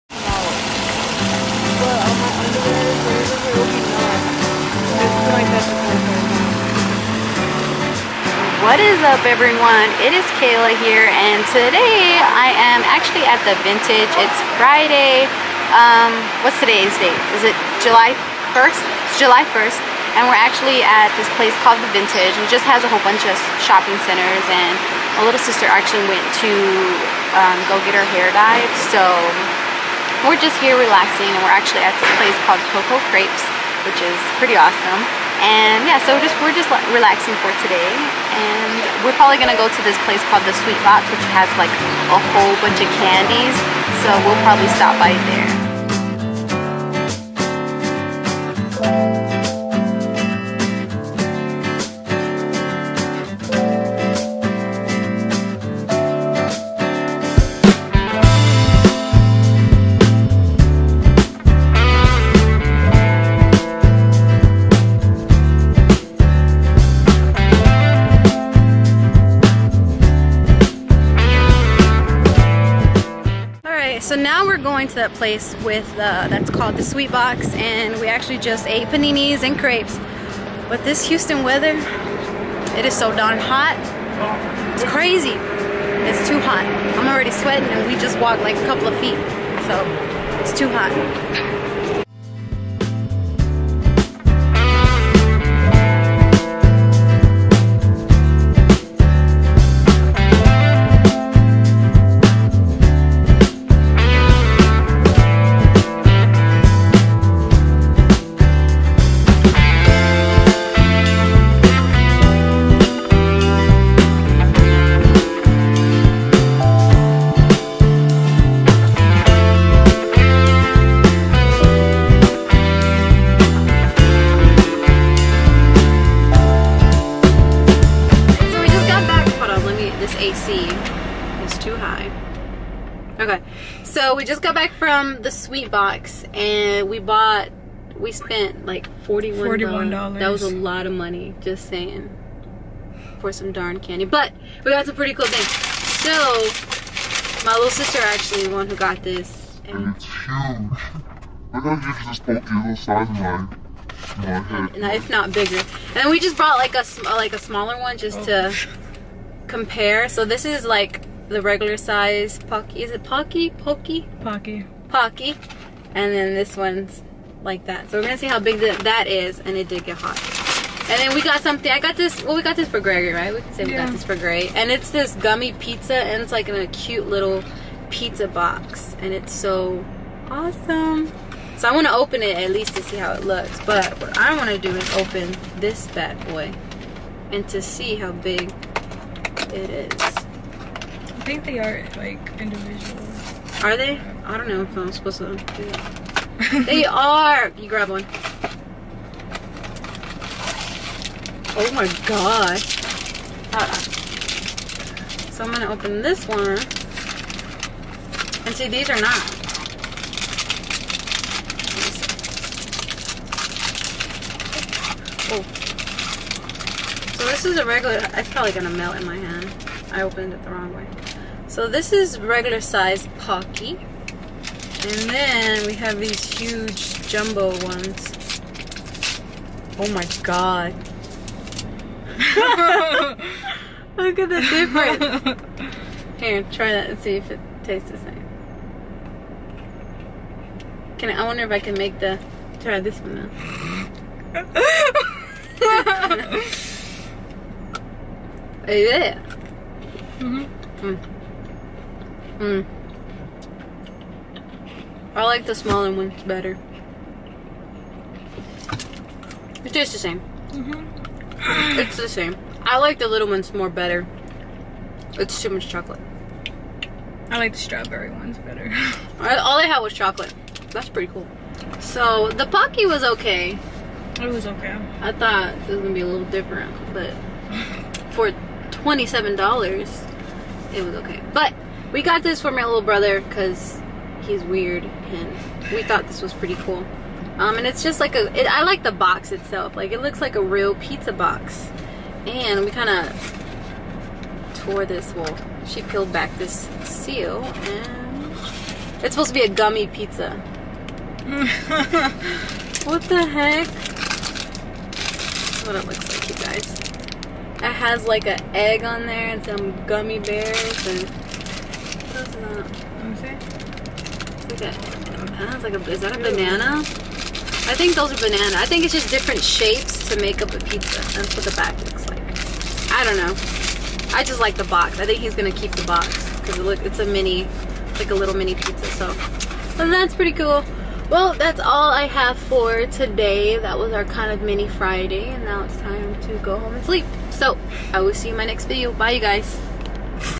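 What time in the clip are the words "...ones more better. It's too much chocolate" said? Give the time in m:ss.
4:23.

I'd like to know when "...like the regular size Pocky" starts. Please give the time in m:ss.
2:40.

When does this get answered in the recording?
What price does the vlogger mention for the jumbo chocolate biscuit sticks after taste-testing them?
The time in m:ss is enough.
4:38.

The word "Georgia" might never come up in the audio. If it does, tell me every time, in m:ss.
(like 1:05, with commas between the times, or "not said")
not said.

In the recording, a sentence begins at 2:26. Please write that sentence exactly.
So, my little sister actually the one who got this.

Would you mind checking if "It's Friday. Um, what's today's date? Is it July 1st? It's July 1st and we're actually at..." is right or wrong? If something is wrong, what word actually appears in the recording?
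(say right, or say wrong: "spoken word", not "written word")
right.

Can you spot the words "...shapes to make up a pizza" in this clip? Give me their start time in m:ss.
5:19.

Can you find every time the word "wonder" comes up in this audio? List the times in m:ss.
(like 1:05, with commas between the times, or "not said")
4:01.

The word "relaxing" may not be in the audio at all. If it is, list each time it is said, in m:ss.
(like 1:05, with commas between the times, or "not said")
0:30, 0:36.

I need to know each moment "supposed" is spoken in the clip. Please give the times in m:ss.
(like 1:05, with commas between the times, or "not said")
3:14, 4:59.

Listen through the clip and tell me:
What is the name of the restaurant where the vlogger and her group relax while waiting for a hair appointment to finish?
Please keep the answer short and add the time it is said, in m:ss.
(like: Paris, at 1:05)
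Coco Crepes, at 0:32.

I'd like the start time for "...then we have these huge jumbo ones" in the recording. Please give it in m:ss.
3:45.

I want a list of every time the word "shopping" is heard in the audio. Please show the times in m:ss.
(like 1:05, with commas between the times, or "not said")
0:23.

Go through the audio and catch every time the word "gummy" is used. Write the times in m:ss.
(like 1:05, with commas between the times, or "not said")
2:55, 4:59, 5:09.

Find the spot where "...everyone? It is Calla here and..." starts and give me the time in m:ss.
0:09.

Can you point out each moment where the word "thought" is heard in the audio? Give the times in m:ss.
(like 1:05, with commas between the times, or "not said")
4:35, 4:45.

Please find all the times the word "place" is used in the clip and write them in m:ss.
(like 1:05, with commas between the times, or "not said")
0:21, 0:32, 0:40, 1:15.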